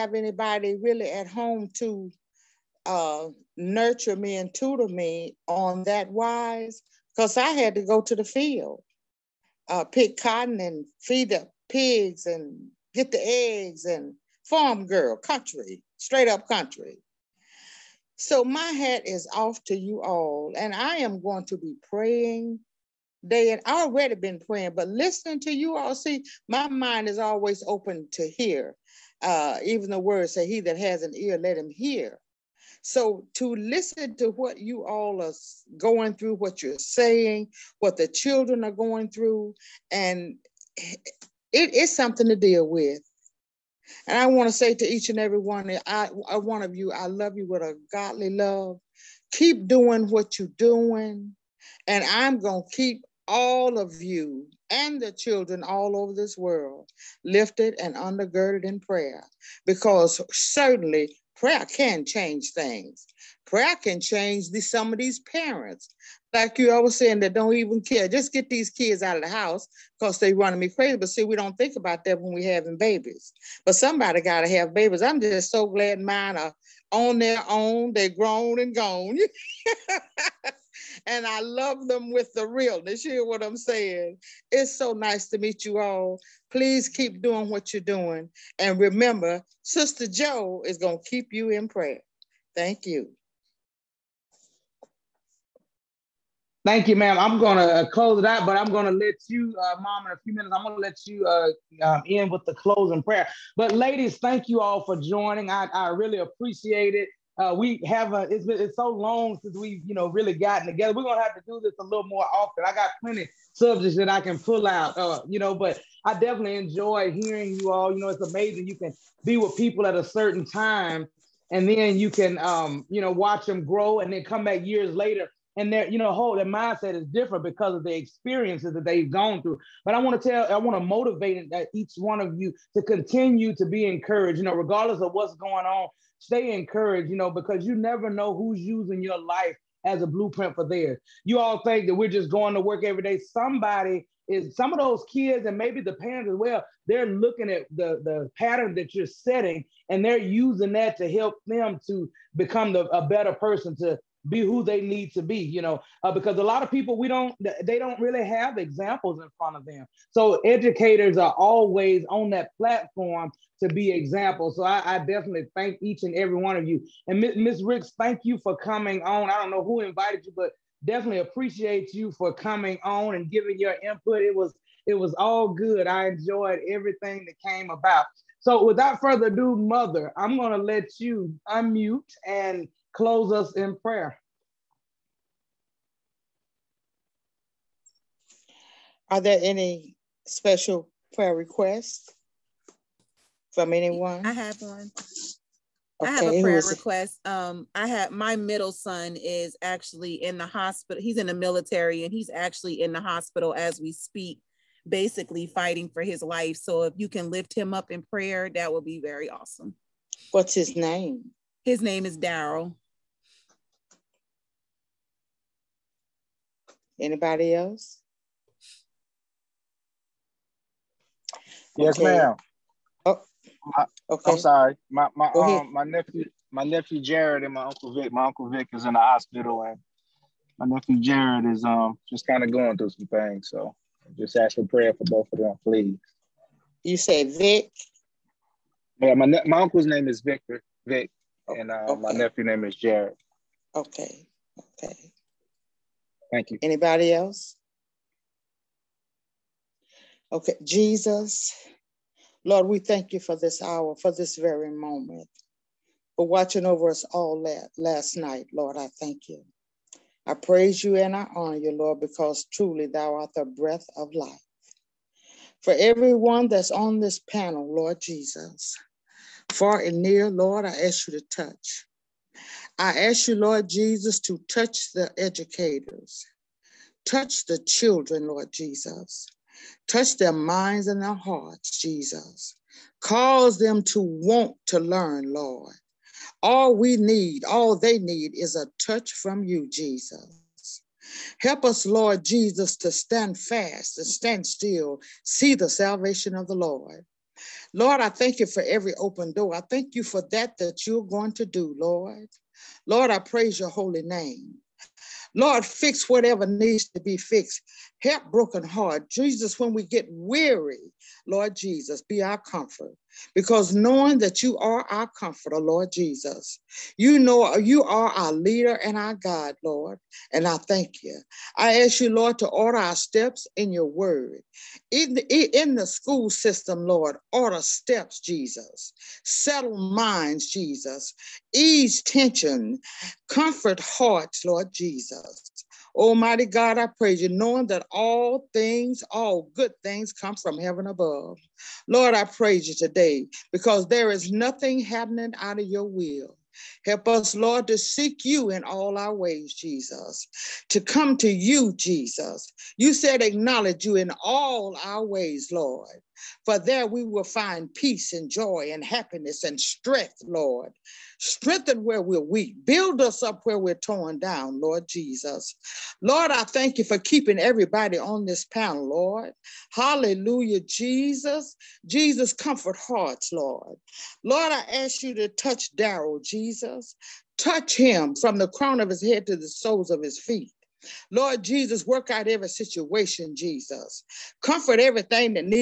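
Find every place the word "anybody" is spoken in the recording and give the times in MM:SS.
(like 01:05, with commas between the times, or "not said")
00:00, 03:36, 04:06.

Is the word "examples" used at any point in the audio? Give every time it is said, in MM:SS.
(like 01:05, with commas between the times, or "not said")
02:38, 02:43.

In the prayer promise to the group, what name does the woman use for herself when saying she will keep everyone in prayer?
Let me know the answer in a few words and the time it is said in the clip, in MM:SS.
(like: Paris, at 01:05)
Sister Joe, at 01:29.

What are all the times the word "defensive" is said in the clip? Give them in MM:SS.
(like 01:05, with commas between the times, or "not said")
not said.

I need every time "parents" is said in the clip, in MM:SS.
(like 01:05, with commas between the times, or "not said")
01:05, 02:25.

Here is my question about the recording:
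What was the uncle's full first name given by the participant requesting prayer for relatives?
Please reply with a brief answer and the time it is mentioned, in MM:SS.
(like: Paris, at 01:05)
Victor, at 04:00.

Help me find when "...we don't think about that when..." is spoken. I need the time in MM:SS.
01:11.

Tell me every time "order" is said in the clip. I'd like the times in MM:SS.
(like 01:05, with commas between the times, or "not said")
05:22, 05:27.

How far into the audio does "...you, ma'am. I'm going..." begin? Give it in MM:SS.
01:36.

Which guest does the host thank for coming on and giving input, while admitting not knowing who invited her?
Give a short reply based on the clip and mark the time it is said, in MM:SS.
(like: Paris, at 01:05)
Miss Ricks, at 02:47.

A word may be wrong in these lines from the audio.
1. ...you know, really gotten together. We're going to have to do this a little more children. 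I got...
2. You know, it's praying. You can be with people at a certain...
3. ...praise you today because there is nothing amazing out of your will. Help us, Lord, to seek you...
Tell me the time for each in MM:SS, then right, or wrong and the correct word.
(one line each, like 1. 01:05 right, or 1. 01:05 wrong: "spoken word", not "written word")
1. 01:49 wrong: "often", not "children"
2. 01:57 wrong: "amazing", not "praying"
3. 05:42 wrong: "happening", not "amazing".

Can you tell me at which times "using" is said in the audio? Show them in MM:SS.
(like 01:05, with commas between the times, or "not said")
02:18, 02:30.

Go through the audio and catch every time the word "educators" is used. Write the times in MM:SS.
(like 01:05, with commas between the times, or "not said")
02:40, 04:35.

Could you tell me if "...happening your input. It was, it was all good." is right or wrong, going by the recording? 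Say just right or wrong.
wrong.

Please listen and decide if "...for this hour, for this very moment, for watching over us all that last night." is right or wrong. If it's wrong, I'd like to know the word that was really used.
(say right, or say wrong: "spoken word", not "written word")
right.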